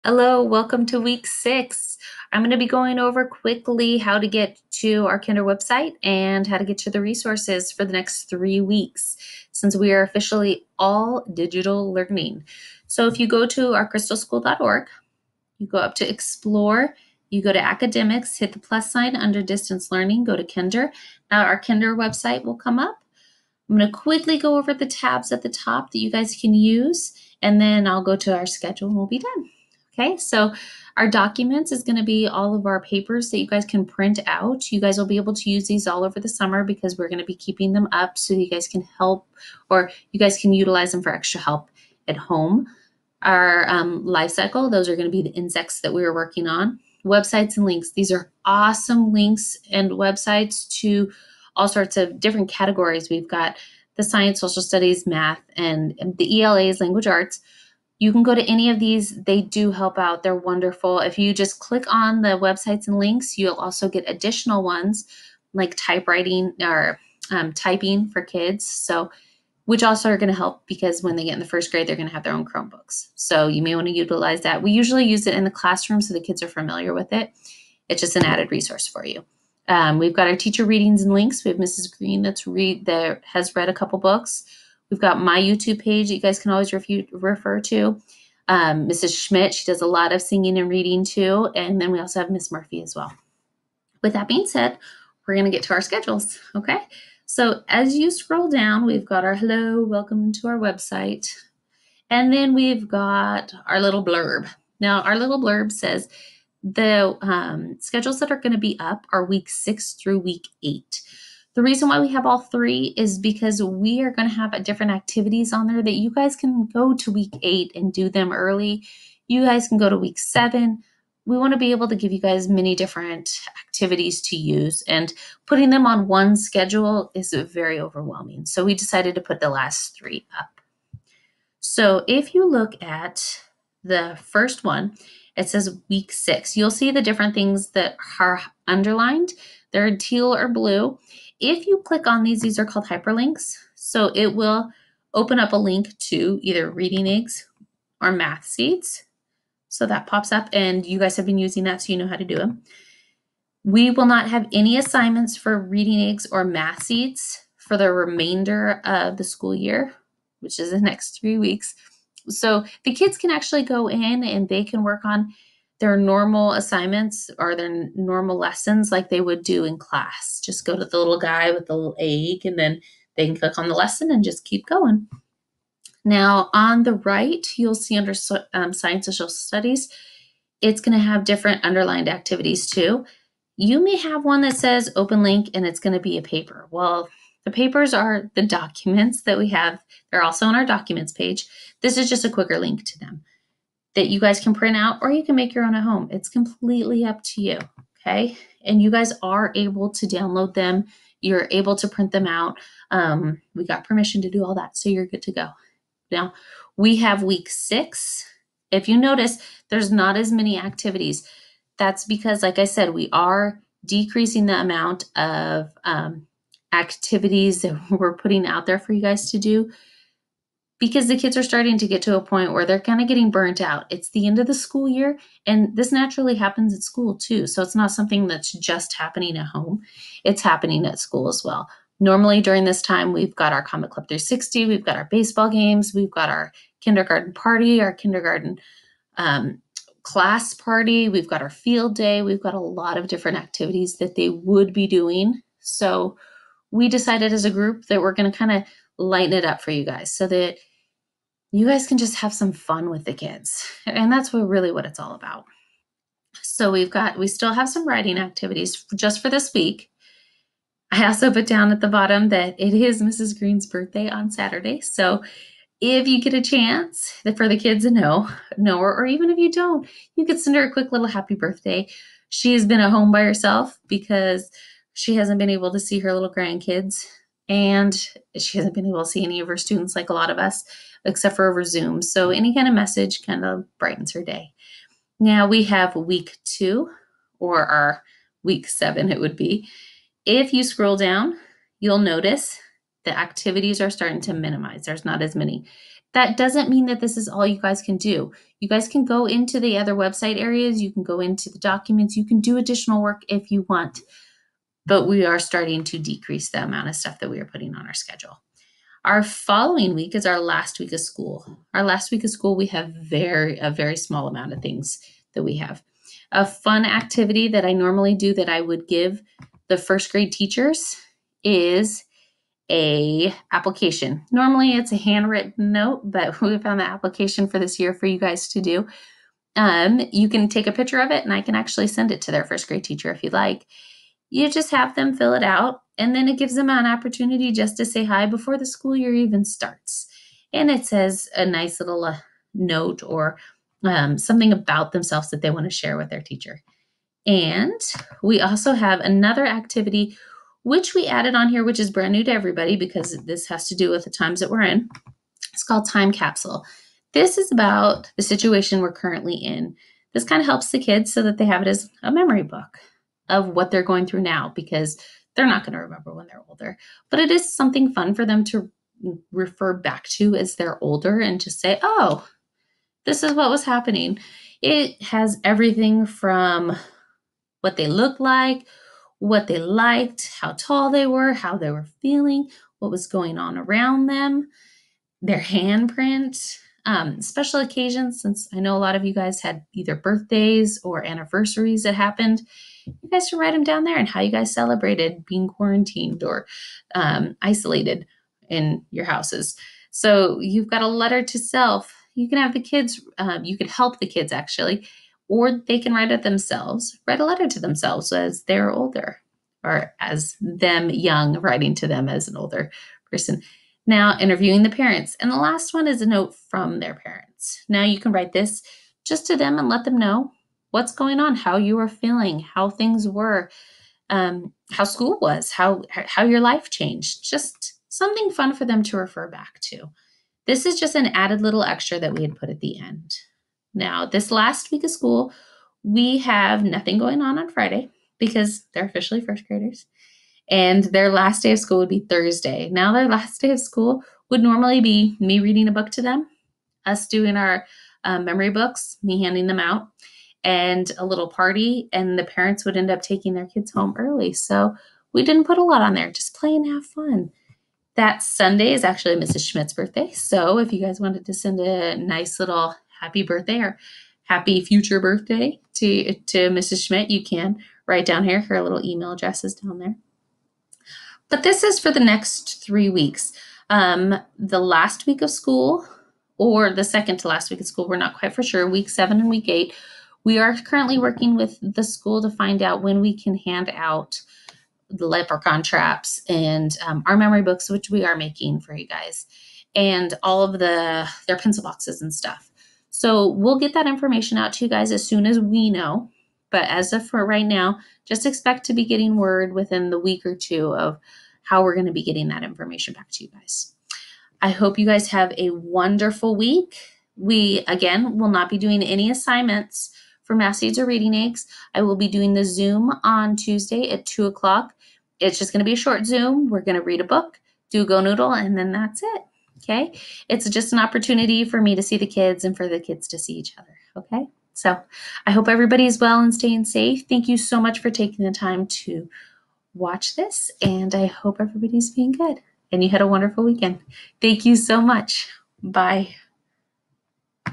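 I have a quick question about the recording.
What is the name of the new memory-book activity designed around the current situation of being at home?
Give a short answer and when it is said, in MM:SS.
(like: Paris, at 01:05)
Time Capsule, at 05:55.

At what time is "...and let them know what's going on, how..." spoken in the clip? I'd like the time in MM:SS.
06:59.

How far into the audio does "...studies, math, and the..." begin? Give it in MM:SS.
00:54.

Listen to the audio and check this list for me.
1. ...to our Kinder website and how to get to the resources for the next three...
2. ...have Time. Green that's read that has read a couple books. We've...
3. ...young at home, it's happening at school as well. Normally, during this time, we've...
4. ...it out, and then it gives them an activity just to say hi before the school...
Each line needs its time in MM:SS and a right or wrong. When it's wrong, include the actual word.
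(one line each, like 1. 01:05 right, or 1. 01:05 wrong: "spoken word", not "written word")
1. 00:04 right
2. 01:21 wrong: "Mrs", not "Time"
3. 03:48 wrong: "happening", not "young"
4. 05:35 wrong: "opportunity", not "activity".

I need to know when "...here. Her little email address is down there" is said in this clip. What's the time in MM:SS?
07:48.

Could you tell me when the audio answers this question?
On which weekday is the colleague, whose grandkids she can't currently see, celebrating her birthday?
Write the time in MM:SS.
04:24.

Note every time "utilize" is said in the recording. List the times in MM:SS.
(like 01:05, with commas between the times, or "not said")
00:40, 01:13.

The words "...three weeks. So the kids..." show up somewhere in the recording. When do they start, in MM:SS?
02:41.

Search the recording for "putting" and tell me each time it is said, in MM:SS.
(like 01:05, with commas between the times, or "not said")
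02:05, 03:38, 05:07.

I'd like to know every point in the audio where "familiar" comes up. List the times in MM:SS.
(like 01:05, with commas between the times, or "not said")
01:16.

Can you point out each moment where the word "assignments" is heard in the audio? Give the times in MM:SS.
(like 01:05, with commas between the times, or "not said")
02:34, 02:46, 08:29.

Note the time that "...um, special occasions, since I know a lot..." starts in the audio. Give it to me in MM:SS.
06:26.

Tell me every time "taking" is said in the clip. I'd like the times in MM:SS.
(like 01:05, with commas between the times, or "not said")
07:33, 08:47.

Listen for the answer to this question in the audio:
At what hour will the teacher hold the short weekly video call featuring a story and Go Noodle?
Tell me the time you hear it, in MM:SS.
08:34.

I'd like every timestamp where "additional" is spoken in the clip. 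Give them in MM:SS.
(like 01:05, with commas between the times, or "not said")
01:04, 05:02.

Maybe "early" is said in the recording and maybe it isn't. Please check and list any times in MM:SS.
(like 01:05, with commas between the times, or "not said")
01:58, 07:33.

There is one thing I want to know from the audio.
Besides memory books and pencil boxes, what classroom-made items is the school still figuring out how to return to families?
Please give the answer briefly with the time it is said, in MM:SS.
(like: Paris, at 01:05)
Leprechaun traps, at 08:05.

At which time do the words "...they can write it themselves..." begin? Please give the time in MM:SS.
06:45.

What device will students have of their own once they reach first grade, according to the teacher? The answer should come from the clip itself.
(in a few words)
Chromebooks.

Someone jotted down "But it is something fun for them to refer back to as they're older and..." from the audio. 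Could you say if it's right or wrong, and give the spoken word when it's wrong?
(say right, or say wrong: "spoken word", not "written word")
right.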